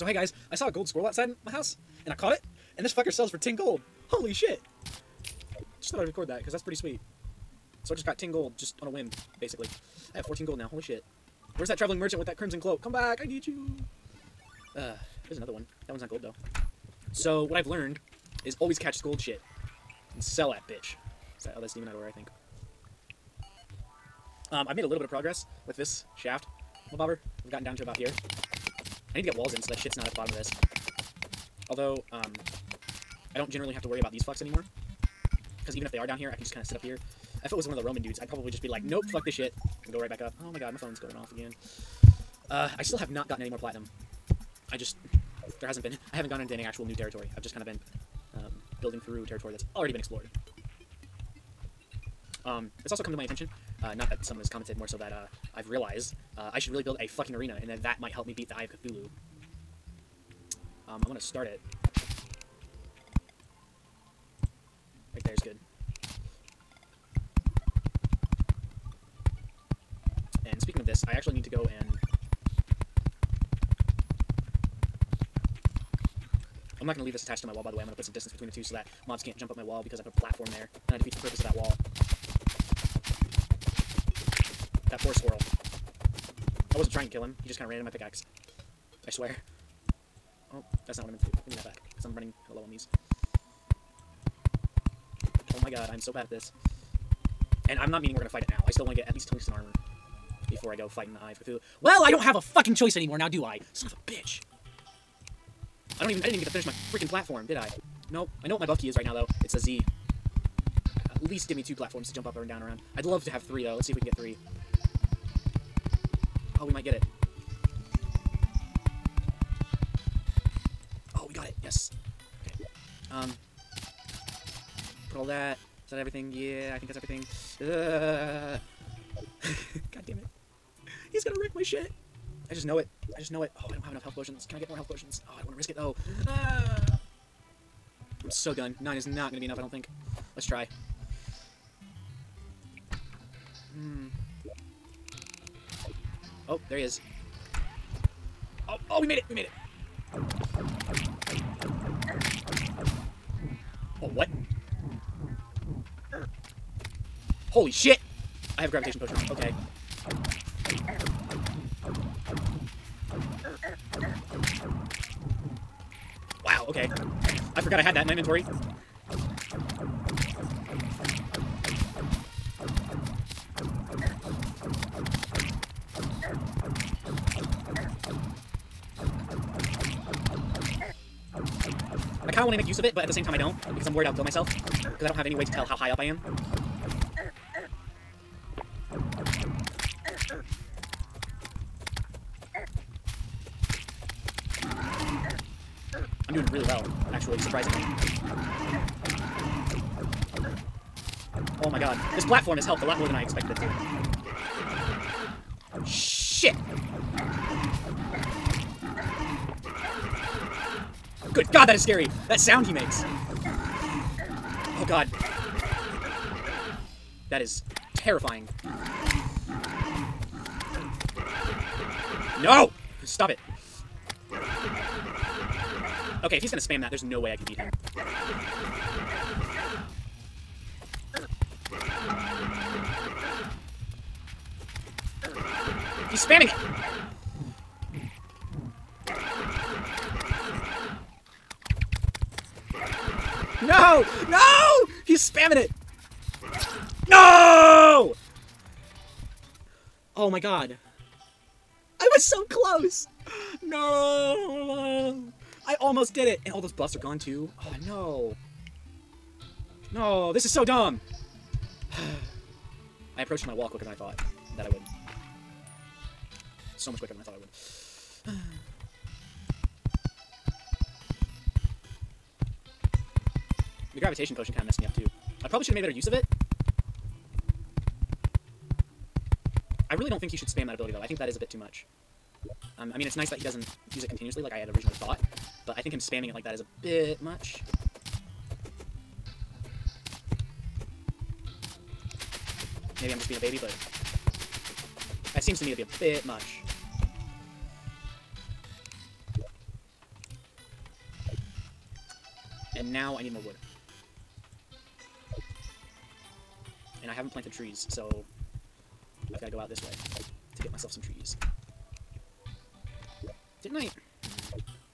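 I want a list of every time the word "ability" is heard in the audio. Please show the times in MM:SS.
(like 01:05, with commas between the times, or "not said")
04:40.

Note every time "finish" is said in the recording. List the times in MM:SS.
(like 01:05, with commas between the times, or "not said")
01:46.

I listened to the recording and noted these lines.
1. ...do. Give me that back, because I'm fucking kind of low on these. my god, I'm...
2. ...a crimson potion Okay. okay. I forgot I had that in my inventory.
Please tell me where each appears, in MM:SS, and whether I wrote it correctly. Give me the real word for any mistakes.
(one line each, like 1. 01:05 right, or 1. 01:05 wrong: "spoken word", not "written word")
1. 01:31 wrong: "running", not "fucking"
2. 02:38 wrong: "gravitation", not "crimson".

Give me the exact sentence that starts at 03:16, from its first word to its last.
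I'm doing really well, actually, surprisingly.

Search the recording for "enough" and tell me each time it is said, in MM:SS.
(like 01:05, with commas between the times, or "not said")
02:13, 02:19.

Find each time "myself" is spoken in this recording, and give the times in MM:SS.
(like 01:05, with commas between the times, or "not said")
03:04, 05:10.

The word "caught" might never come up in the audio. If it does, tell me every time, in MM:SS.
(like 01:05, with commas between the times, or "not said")
00:02.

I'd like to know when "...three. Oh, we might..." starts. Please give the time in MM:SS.
01:54.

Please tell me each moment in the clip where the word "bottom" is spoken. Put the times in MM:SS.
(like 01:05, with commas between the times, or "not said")
00:30.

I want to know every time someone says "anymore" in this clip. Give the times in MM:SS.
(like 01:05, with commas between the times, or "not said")
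00:34, 01:42.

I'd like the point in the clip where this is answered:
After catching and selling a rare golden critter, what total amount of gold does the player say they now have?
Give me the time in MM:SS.
00:10.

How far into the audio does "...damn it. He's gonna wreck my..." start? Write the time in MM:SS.
02:10.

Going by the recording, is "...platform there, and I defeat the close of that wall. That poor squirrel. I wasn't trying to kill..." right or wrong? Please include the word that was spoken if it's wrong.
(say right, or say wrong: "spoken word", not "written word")
wrong: "purpose", not "close".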